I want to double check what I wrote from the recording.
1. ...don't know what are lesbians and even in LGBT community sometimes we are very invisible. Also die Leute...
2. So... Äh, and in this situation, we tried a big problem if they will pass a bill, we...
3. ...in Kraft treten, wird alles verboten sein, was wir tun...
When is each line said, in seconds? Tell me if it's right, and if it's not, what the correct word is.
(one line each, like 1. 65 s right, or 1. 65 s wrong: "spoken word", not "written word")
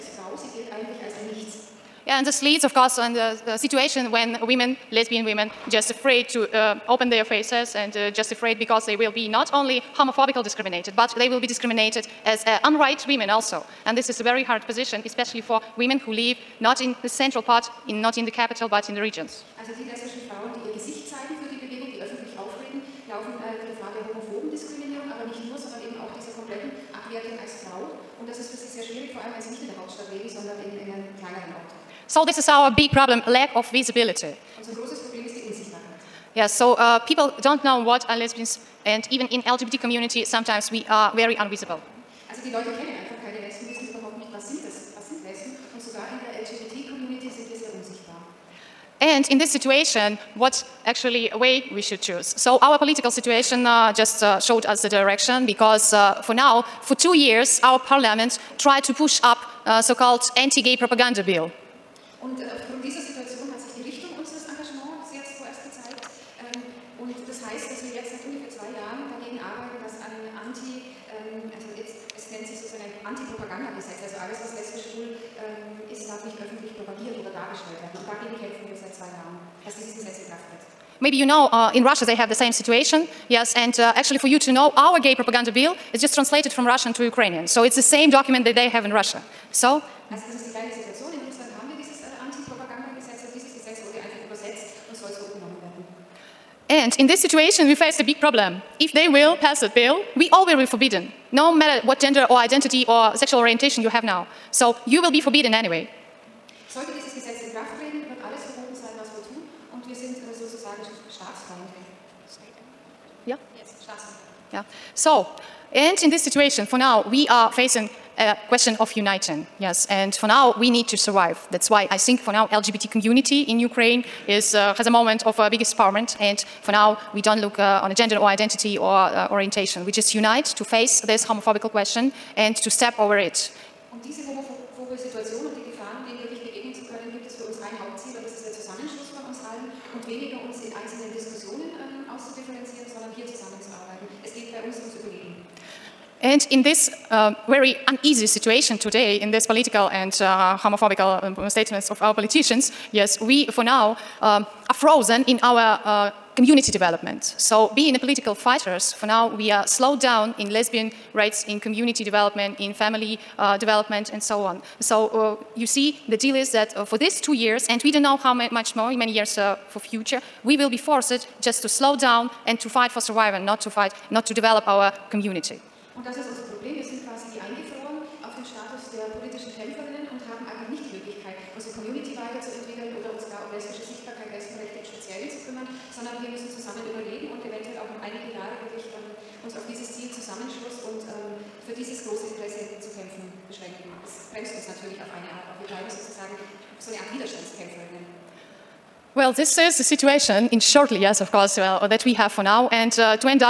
1. 37 s right
2. 89 s wrong: "faced", not "tried"
3. 107 s right.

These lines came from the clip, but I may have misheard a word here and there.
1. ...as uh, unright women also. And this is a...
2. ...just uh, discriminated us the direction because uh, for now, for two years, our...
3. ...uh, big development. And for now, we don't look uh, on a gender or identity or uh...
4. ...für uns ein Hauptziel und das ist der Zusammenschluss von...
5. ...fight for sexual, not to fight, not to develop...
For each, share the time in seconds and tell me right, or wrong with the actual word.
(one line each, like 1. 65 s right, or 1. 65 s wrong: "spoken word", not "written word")
1. 12 s right
2. 53 s wrong: "showed", not "discriminated"
3. 125 s wrong: "empowerment", not "development"
4. 137 s right
5. 172 s wrong: "survival", not "sexual".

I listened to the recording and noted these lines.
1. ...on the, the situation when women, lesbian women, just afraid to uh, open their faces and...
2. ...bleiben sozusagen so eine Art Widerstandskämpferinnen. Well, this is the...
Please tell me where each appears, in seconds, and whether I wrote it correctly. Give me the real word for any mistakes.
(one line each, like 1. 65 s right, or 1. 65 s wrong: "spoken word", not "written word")
1. 2 s right
2. 195 s right.